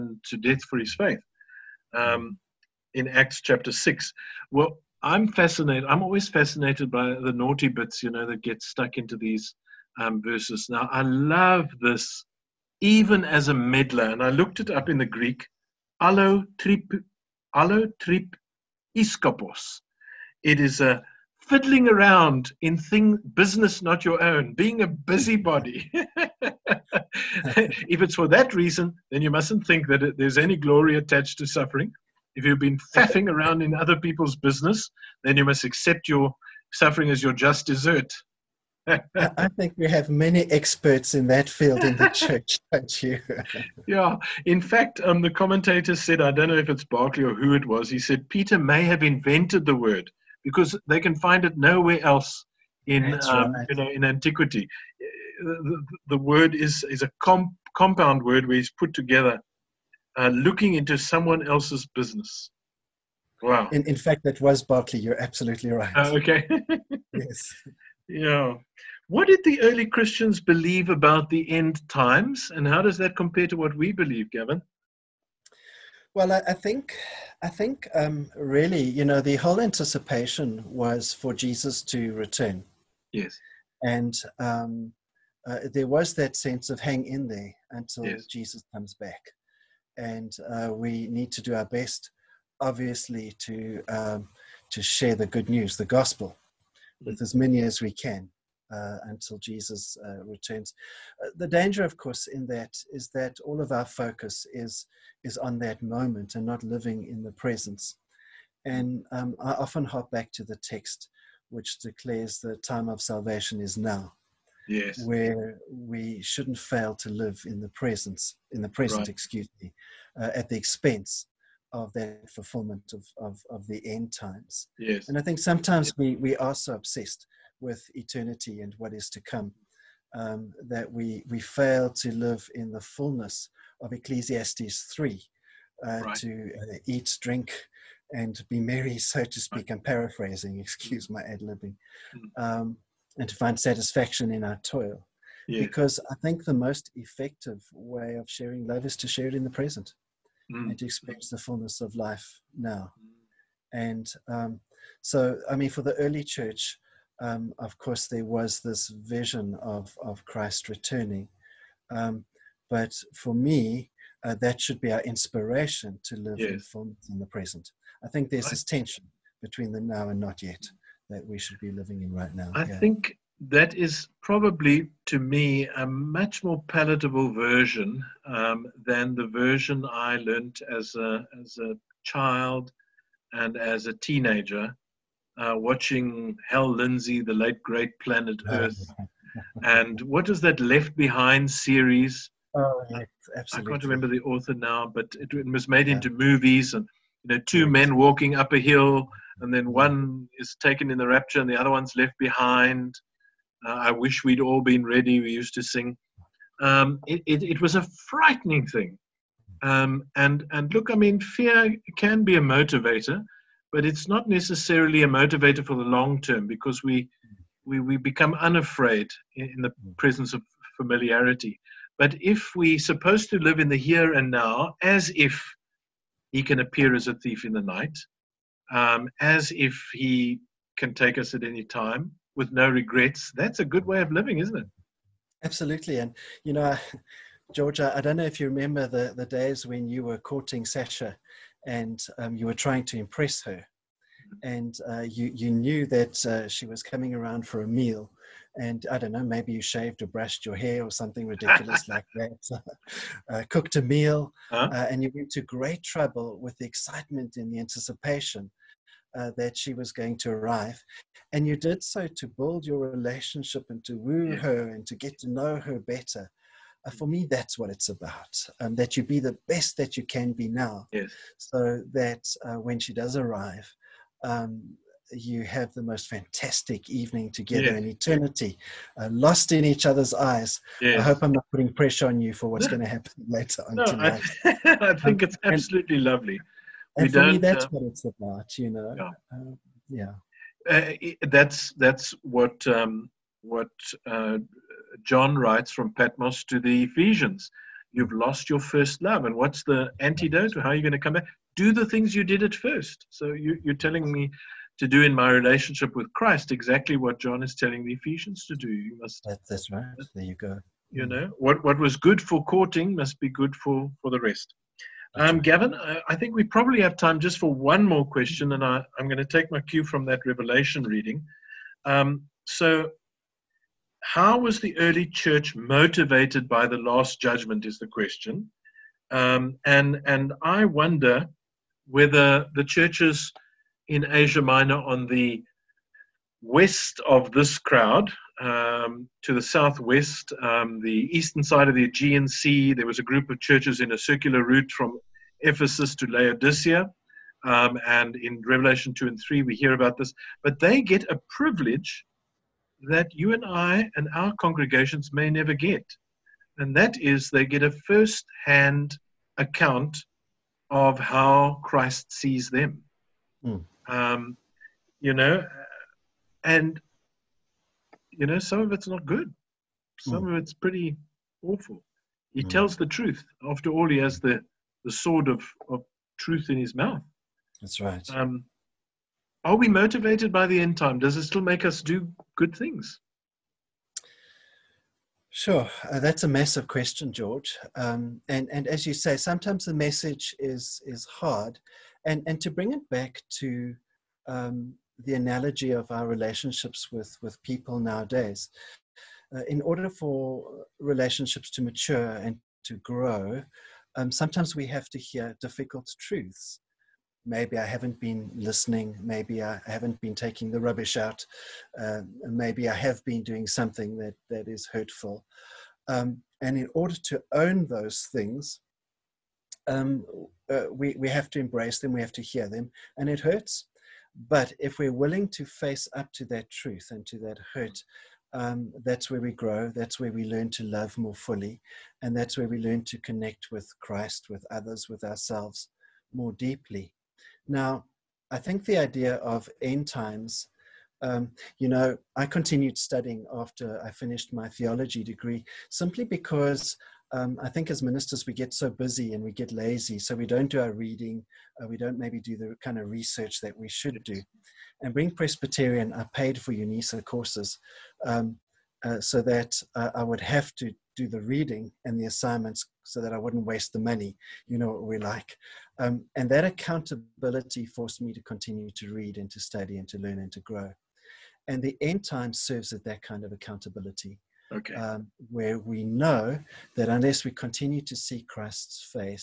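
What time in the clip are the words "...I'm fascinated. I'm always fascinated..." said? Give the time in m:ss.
0:05.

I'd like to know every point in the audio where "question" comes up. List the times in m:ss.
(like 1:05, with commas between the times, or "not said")
5:18, 5:27, 6:26.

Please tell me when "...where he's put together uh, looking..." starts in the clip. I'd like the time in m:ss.
0:58.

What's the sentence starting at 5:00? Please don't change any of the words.
How are you going to come back?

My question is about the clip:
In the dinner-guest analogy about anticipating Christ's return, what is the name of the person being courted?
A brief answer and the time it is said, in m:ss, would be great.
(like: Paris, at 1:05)
Sasha, at 4:00.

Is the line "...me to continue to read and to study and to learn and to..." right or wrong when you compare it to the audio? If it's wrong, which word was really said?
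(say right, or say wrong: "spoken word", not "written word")
right.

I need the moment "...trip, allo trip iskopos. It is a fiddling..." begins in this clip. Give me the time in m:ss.
0:16.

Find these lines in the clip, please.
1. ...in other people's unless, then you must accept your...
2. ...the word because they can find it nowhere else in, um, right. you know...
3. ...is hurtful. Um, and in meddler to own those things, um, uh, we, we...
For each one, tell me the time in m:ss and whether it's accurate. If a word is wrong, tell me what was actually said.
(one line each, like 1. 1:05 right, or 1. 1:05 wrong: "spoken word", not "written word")
1. 0:33 wrong: "business", not "unless"
2. 0:49 right
3. 6:54 wrong: "order", not "meddler".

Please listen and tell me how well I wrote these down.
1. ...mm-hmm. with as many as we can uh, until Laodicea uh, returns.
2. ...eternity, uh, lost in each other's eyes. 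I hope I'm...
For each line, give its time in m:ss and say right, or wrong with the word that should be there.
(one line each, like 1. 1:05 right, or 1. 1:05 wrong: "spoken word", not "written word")
1. 1:36 wrong: "Jesus", not "Laodicea"
2. 4:37 right.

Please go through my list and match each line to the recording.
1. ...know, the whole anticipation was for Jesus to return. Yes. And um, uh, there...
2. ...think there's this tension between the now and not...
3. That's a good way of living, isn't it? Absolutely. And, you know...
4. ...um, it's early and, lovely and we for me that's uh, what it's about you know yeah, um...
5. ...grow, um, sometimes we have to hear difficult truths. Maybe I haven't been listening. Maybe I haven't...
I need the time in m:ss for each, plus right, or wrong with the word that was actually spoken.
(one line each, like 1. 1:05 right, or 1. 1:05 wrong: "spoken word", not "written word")
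1. 1:19 right
2. 2:48 right
3. 3:53 right
4. 4:45 wrong: "absolutely", not "early"
5. 6:42 right.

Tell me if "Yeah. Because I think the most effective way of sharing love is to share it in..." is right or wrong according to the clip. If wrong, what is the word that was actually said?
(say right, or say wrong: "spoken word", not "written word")
right.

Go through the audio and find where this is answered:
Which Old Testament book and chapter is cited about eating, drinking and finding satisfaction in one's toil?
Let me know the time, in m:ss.
2:13.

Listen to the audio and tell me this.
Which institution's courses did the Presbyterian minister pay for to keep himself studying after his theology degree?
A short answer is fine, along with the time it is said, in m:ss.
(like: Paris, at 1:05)
UNISA, at 7:36.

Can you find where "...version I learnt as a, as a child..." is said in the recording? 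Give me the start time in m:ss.
2:59.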